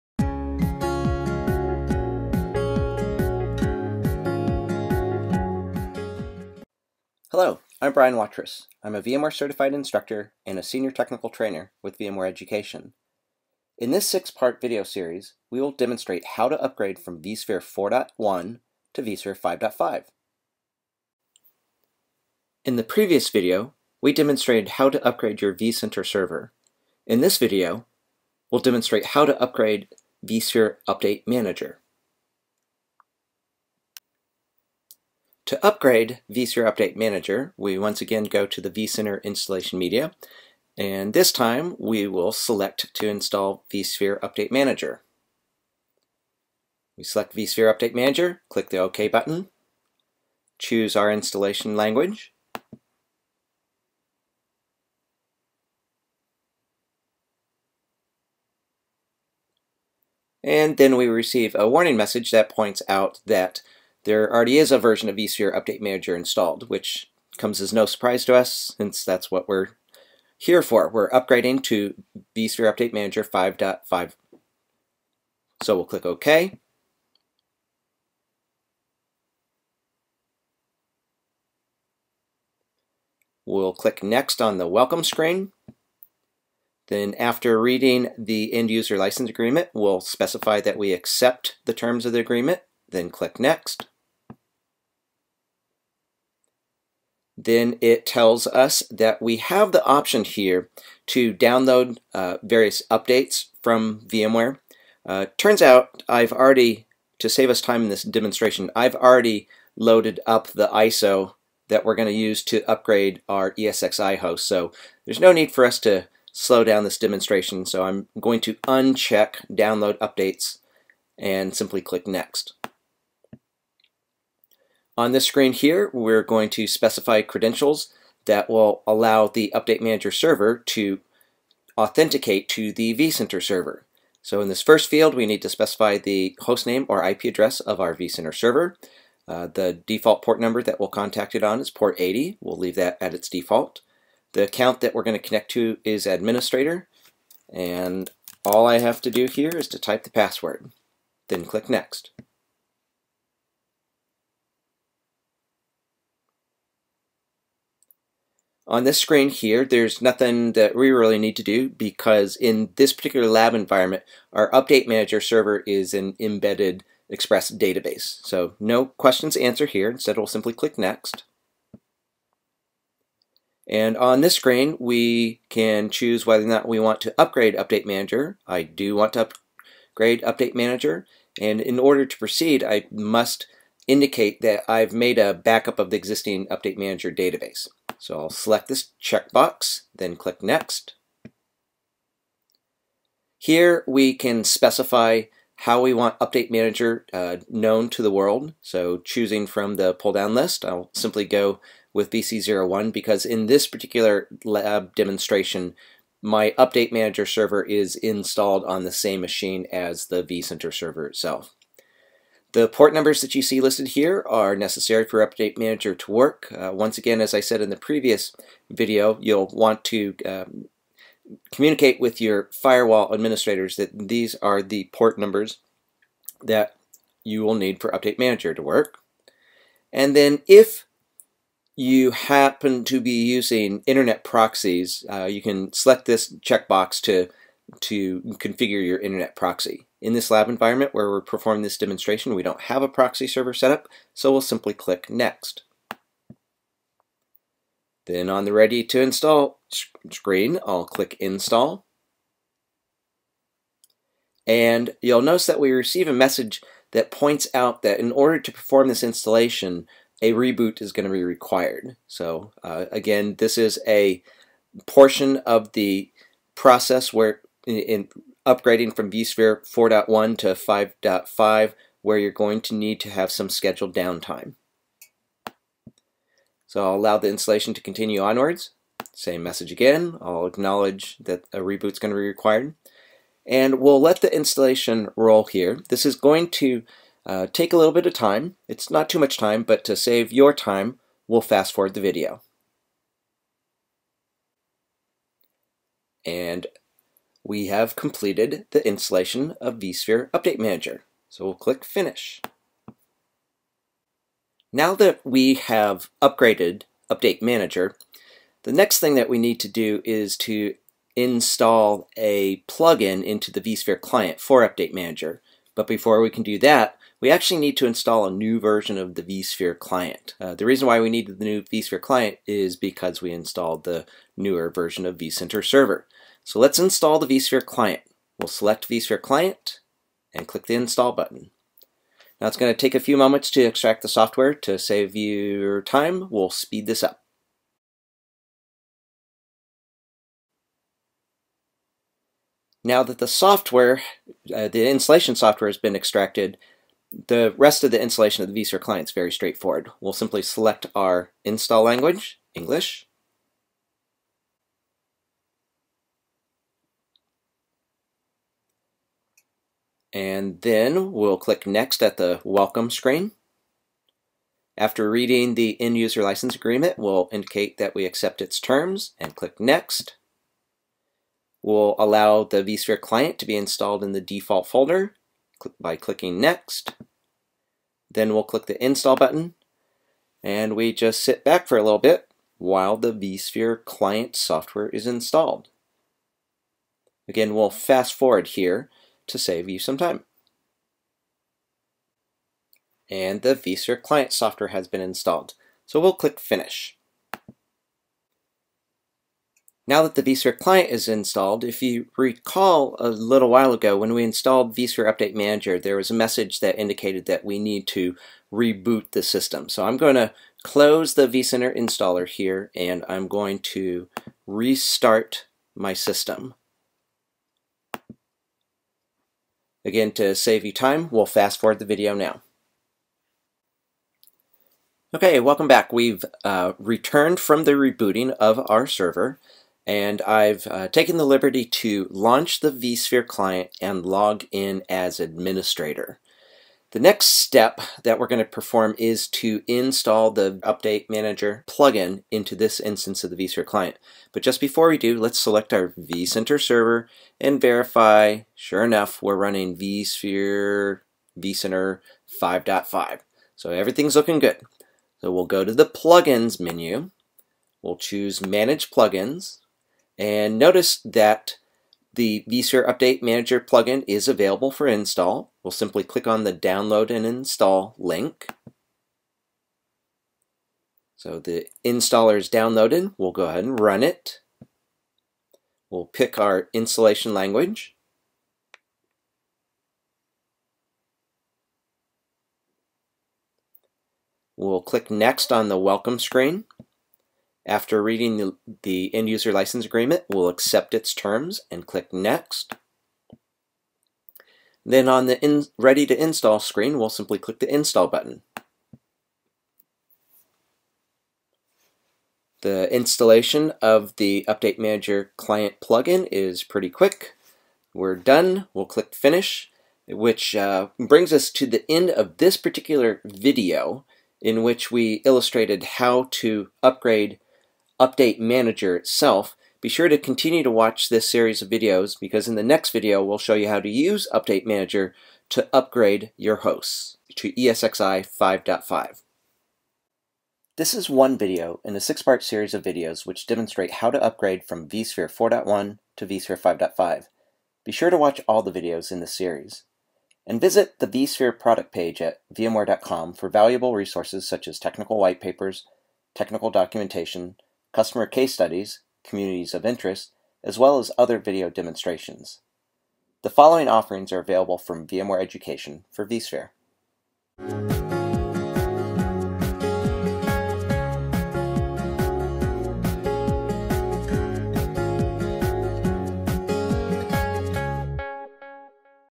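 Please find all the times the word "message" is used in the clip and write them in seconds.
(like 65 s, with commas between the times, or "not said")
61 s, 256 s, 279 s, 406 s.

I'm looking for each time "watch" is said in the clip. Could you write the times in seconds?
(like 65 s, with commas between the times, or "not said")
520 s, 538 s.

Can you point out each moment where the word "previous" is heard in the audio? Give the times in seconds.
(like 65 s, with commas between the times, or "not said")
22 s, 217 s.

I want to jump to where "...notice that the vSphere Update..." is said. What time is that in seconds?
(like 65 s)
460 s.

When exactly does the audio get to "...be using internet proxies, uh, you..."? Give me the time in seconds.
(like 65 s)
232 s.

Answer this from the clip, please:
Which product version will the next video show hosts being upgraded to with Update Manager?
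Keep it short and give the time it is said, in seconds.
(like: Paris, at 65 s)
ESXi 5.5, at 527 s.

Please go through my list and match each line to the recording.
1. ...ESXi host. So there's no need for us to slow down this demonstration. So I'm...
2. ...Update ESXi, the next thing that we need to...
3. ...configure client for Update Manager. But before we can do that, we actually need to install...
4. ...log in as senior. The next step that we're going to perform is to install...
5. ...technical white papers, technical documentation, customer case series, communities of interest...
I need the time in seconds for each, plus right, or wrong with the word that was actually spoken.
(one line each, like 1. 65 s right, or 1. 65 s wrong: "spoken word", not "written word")
1. 113 s right
2. 307 s wrong: "Manager", not "ESXi"
3. 313 s wrong: "vSphere", not "configure"
4. 434 s wrong: "administrator", not "senior"
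5. 544 s wrong: "studies", not "series".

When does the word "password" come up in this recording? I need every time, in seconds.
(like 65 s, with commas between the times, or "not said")
150 s.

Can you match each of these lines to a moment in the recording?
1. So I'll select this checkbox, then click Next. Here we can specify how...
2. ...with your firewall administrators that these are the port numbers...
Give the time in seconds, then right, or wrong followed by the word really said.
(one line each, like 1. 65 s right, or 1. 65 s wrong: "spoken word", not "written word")
1. 187 s right
2. 222 s right.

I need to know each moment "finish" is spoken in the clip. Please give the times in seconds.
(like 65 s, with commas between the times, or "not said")
301 s, 396 s, 509 s.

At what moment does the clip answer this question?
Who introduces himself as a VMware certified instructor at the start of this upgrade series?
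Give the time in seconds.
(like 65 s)
7 s.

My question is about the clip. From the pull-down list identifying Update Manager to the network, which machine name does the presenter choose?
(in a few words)
VC one.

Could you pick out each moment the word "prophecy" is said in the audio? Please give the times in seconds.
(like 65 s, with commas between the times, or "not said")
not said.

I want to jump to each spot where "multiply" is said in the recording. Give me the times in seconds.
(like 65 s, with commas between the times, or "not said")
not said.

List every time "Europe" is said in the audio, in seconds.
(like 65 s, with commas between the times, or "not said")
not said.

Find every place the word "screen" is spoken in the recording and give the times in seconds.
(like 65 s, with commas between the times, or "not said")
85 s, 125 s, 158 s, 174 s, 250 s, 362 s, 486 s, 496 s.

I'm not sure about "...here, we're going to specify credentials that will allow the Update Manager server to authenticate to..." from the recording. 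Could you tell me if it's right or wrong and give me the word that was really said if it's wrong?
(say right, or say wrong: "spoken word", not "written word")
right.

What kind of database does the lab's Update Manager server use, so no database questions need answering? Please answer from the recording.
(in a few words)
embedded Express database.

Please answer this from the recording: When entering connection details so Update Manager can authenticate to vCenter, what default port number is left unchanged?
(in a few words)
80.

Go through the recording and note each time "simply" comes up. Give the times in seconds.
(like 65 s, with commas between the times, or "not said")
121 s, 170 s, 200 s, 244 s, 350 s, 465 s, 497 s.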